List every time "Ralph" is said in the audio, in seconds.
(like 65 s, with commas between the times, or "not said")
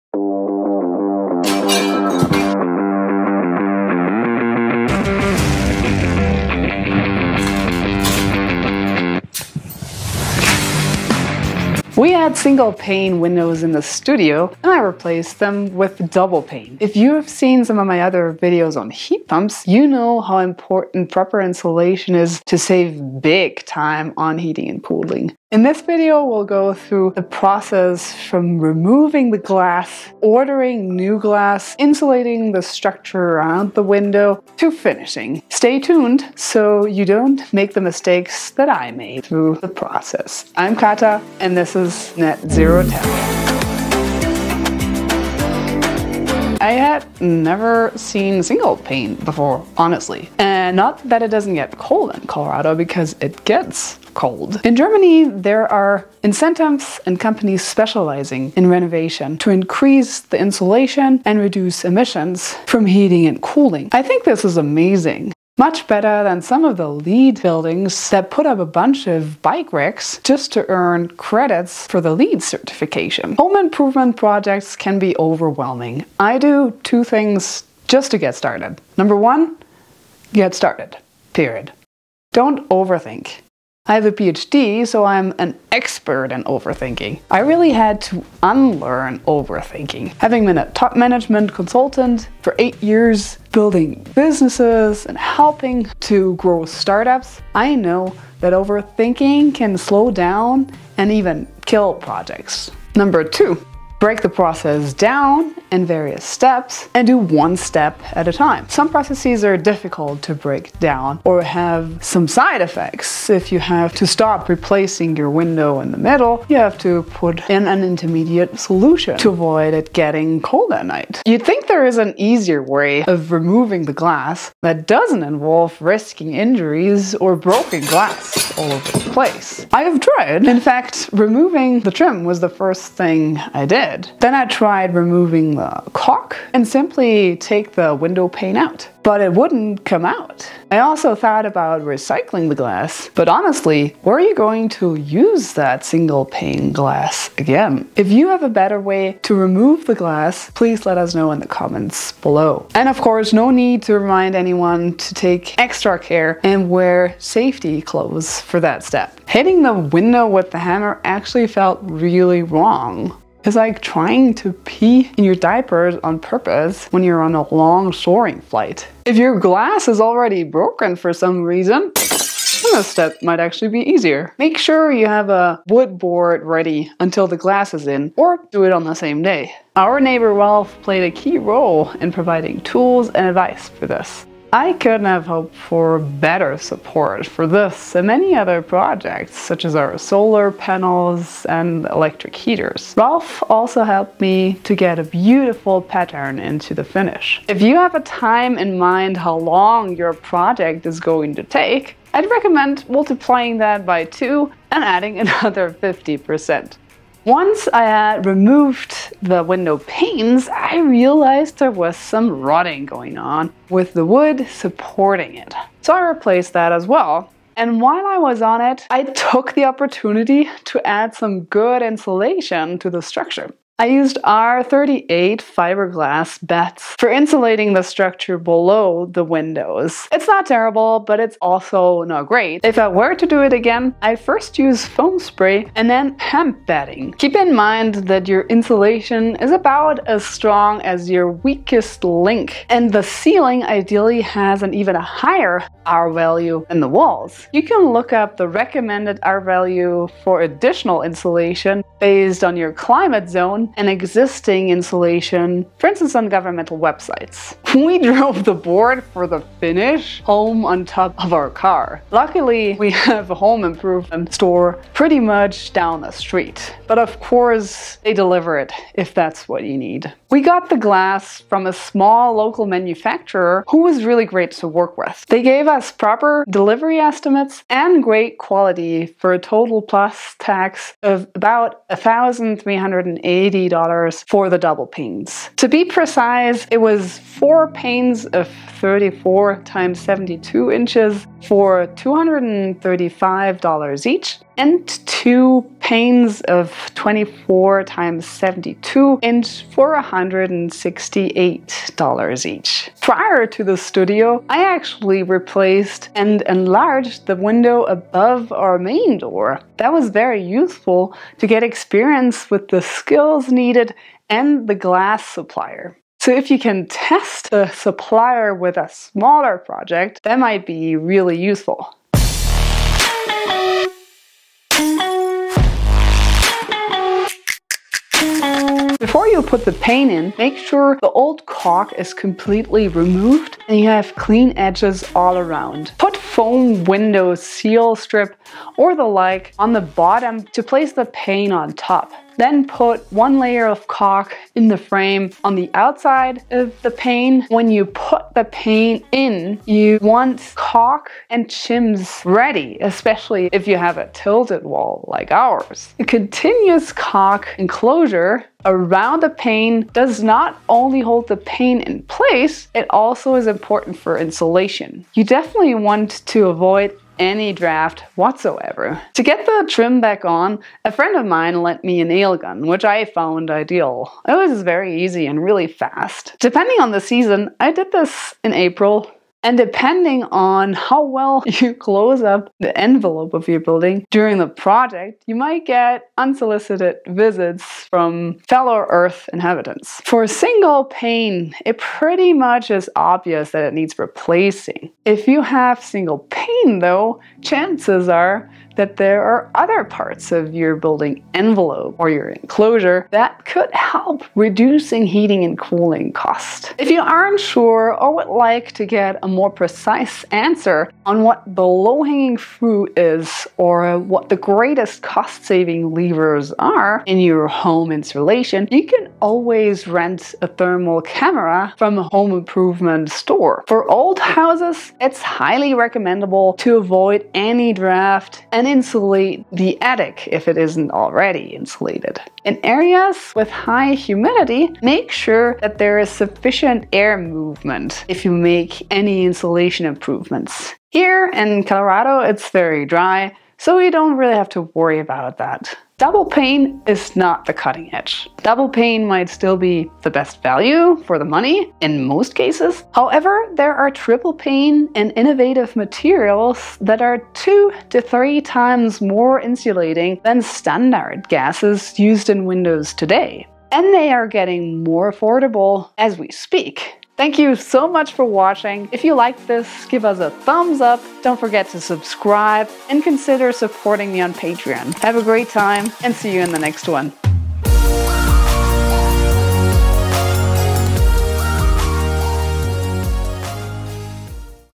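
180 s, 192 s.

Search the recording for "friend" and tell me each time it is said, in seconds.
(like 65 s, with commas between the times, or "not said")
370 s.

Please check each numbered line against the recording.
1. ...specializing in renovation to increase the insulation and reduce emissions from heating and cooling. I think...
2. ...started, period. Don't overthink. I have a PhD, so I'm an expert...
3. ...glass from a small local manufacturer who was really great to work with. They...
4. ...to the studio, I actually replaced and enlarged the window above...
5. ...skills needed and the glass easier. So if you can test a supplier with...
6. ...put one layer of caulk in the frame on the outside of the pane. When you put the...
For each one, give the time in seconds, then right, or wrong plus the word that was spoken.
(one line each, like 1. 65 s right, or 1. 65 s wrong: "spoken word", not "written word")
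1. 57 s right
2. 80 s right
3. 270 s right
4. 303 s right
5. 312 s wrong: "supplier", not "easier"
6. 342 s right.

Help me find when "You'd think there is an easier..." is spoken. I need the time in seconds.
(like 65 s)
121 s.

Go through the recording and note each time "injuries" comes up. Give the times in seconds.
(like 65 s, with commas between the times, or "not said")
126 s.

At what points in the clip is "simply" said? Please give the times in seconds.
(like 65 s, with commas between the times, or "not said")
136 s.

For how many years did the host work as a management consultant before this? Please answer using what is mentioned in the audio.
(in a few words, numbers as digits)
8.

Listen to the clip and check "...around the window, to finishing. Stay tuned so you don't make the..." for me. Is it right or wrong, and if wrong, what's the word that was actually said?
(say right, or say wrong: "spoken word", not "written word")
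right.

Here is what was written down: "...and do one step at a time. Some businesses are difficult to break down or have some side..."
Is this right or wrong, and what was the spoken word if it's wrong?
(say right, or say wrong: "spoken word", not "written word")
wrong: "processes", not "businesses".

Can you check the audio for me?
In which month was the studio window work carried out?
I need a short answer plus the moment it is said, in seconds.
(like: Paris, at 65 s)
April, at 378 s.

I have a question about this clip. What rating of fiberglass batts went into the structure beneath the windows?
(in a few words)
R38.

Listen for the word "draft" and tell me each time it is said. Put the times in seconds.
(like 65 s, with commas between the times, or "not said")
367 s, 427 s.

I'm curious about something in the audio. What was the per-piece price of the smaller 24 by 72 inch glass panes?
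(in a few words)
$168.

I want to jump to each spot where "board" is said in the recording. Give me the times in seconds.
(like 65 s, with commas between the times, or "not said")
175 s, 258 s.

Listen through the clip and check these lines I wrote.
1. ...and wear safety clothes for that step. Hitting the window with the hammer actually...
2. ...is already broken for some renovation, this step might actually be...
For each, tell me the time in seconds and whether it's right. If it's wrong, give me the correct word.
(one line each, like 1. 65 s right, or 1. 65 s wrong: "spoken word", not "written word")
1. 156 s right
2. 169 s wrong: "reason", not "renovation".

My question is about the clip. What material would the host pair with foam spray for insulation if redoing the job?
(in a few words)
hemp batting.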